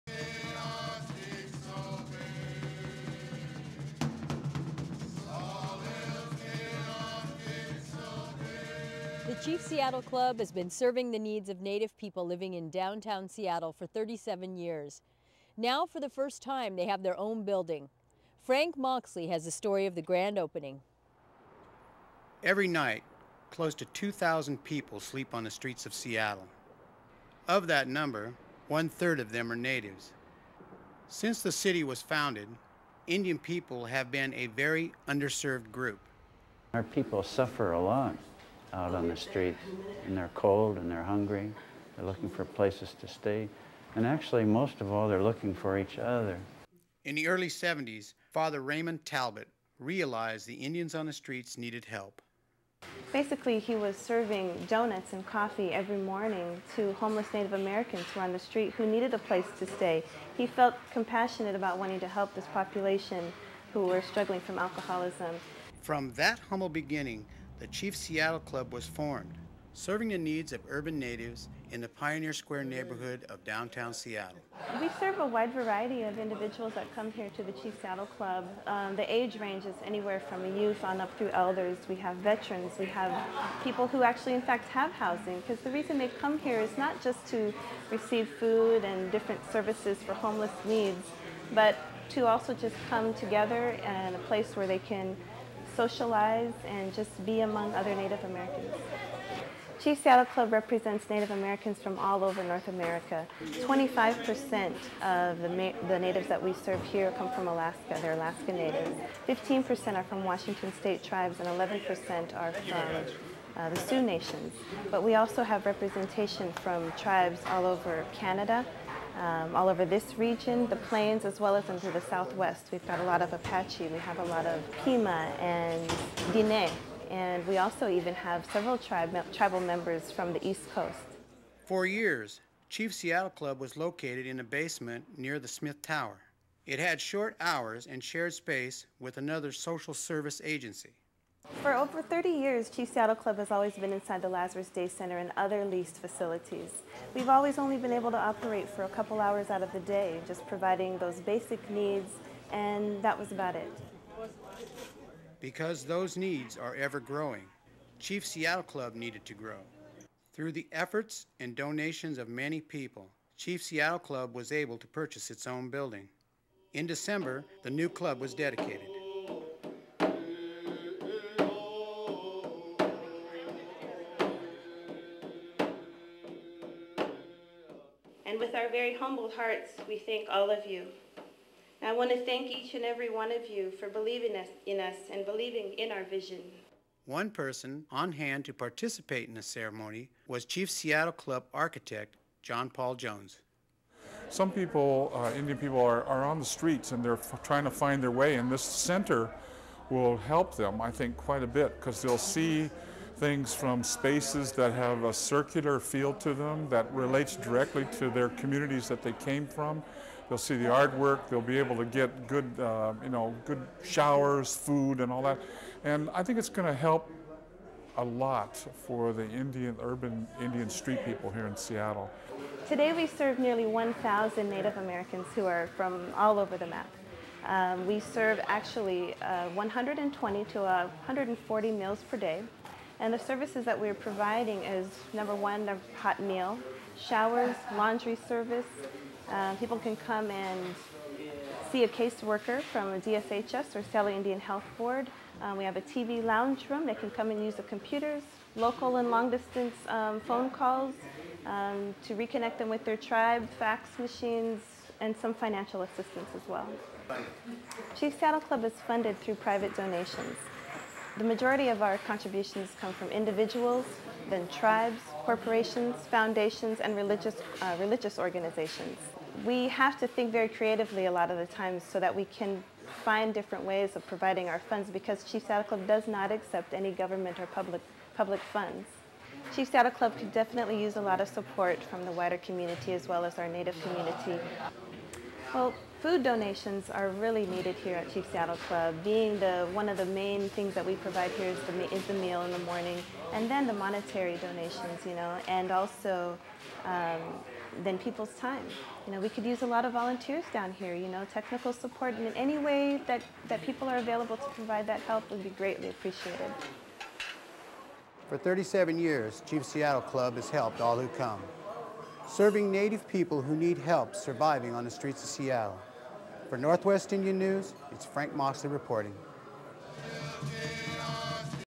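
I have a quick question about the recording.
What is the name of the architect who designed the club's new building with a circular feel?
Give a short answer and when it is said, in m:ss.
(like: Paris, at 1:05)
John Paul Jones, at 3:12.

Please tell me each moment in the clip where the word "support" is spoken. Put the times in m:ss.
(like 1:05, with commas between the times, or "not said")
4:41, 5:01.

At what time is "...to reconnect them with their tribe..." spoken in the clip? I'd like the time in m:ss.
4:12.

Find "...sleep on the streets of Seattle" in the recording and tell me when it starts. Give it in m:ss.
0:24.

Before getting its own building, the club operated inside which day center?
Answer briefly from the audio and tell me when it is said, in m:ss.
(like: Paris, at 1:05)
Lazarus Day Center, at 2:24.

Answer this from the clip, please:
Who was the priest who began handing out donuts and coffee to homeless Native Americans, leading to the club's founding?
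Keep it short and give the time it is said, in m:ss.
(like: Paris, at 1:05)
Father Raymond Talbot, at 0:48.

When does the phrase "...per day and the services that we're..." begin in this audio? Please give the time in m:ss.
3:52.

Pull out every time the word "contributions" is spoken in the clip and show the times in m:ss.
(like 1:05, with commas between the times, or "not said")
4:22.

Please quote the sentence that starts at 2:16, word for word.
It had short hours and shared space with another social service agency.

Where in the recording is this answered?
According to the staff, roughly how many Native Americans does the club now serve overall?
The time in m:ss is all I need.
3:43.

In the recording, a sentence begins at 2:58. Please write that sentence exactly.
with our very humbled hearts, we thank all of you.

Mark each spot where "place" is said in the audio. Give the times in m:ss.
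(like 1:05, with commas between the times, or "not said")
0:42, 0:59, 1:34.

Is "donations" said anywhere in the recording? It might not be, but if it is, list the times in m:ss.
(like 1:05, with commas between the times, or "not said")
2:41, 4:19, 4:46, 4:54.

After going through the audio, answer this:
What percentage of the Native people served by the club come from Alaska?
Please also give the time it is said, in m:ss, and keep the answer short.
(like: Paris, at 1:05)
25%, at 1:43.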